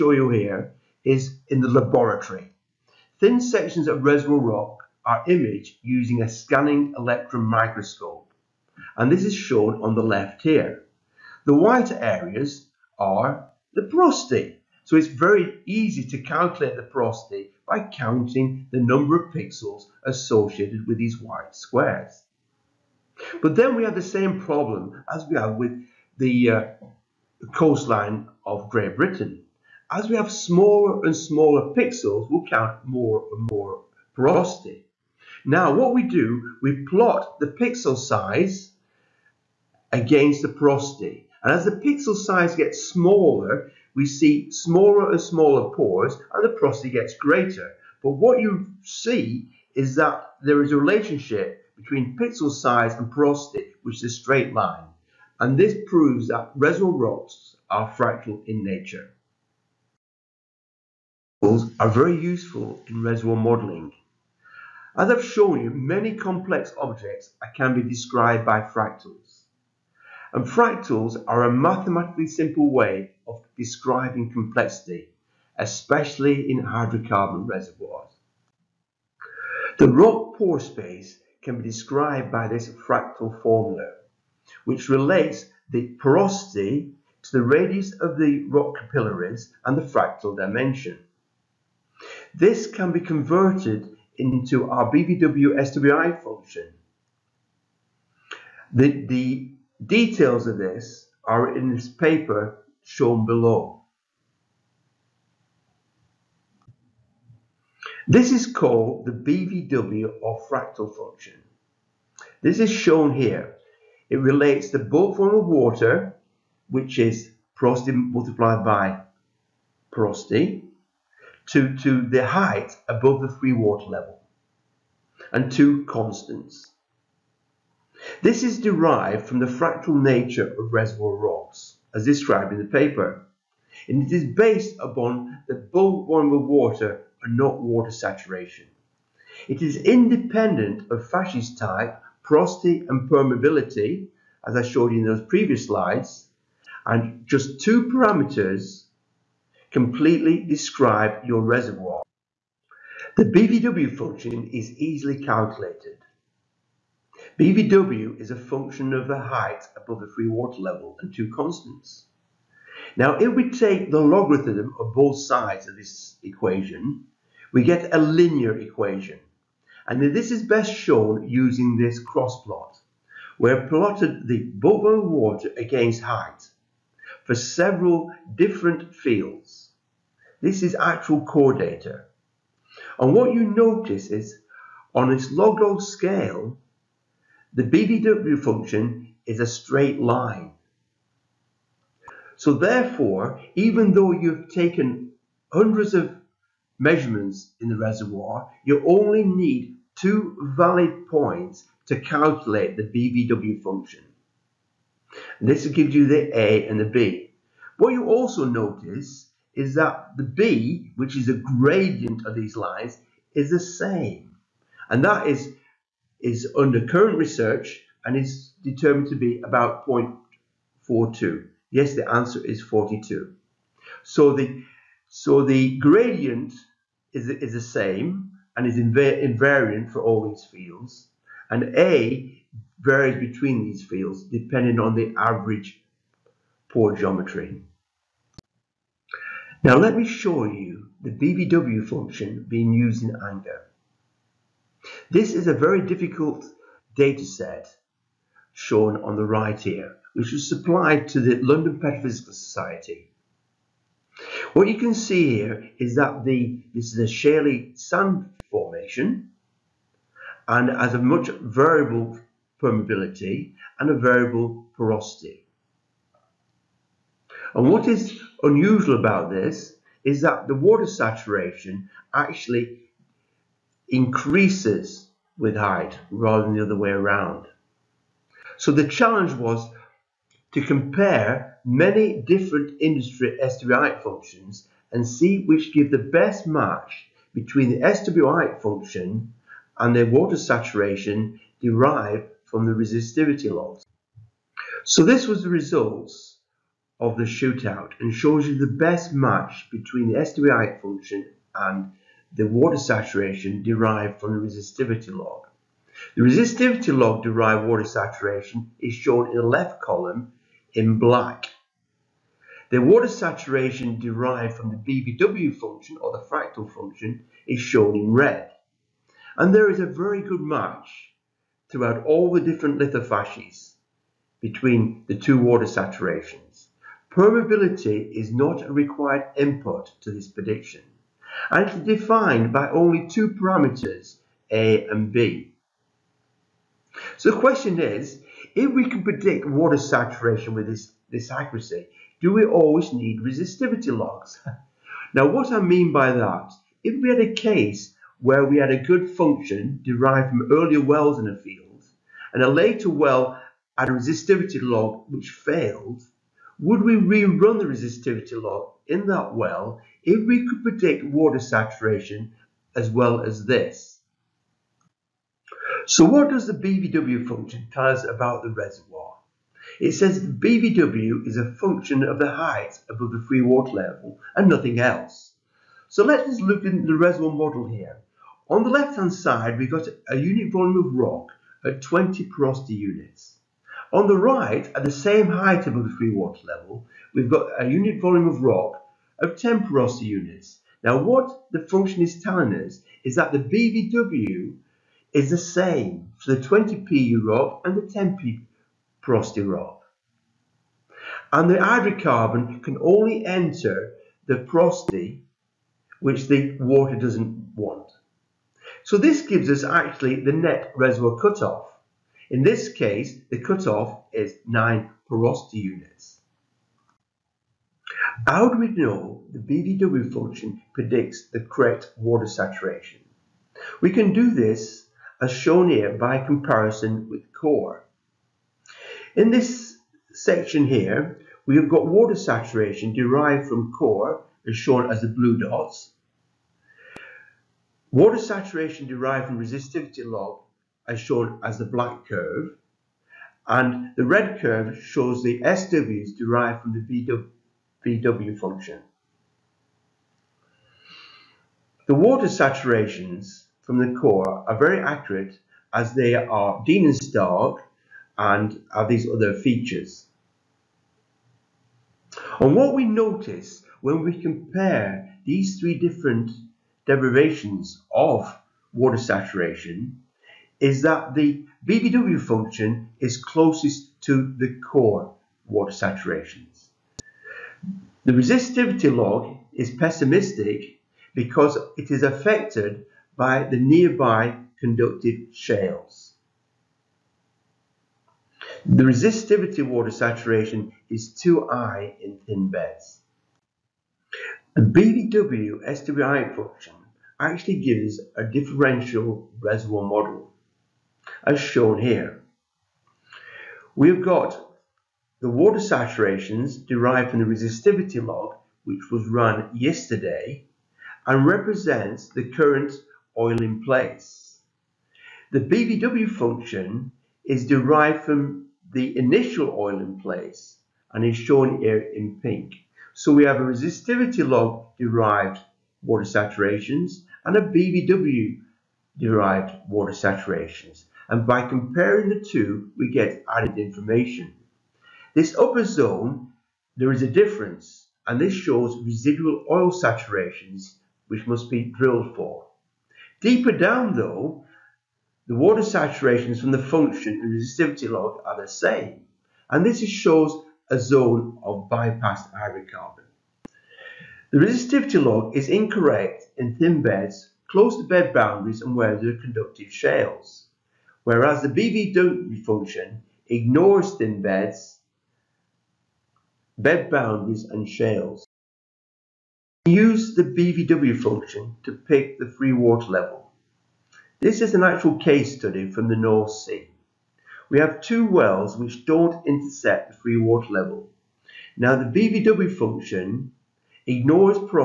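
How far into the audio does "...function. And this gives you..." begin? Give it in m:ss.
3:23.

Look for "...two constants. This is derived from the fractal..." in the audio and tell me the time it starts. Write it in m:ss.
2:05.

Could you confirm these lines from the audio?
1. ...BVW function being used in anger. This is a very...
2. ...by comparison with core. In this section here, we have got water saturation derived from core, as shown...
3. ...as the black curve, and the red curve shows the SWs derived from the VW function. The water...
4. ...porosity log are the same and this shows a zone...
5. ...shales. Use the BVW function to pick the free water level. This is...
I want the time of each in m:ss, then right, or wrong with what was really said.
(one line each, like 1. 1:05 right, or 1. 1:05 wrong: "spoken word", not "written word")
1. 4:01 right
2. 7:05 right
3. 7:21 right
4. 9:07 wrong: "resistivity", not "porosity"
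5. 9:27 right.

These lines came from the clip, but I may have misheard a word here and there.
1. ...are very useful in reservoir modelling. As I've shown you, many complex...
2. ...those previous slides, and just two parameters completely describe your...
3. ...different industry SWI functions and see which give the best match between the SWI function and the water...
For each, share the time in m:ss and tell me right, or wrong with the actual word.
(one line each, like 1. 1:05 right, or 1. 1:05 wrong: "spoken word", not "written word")
1. 1:01 right
2. 2:25 right
3. 4:42 right.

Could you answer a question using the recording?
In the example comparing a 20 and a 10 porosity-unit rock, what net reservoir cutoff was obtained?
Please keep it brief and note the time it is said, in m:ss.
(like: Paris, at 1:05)
9 porosity units, at 6:54.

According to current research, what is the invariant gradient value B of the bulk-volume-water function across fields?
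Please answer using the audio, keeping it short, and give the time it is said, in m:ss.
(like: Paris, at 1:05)
0.42, at 3:39.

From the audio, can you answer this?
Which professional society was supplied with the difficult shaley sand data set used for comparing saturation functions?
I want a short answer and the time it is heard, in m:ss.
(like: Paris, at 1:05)
London Petrophysical Society, at 4:11.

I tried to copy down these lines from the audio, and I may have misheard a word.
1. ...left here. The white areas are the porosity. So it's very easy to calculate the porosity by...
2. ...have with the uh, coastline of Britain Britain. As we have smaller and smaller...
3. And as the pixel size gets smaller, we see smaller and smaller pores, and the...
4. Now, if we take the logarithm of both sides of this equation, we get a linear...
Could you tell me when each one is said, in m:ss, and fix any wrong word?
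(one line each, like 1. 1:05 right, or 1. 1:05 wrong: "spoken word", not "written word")
1. 0:10 right
2. 0:25 wrong: "Great", not "Britain"
3. 0:41 right
4. 2:42 right.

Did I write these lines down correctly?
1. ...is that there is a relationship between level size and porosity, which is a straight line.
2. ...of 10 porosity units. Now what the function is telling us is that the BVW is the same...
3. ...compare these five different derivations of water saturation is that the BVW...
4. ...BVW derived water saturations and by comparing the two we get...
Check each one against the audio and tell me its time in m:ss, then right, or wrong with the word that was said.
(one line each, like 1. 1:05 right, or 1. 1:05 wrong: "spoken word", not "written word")
1. 0:49 wrong: "pixel", not "level"
2. 6:29 right
3. 7:44 wrong: "three", not "five"
4. 8:47 right.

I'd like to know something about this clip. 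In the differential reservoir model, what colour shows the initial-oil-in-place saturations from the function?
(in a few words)
Pink.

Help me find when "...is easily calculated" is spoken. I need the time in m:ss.
2:34.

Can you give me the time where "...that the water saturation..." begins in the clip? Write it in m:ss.
4:30.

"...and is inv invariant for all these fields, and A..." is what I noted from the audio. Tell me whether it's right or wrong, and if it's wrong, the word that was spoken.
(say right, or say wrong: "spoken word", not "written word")
right.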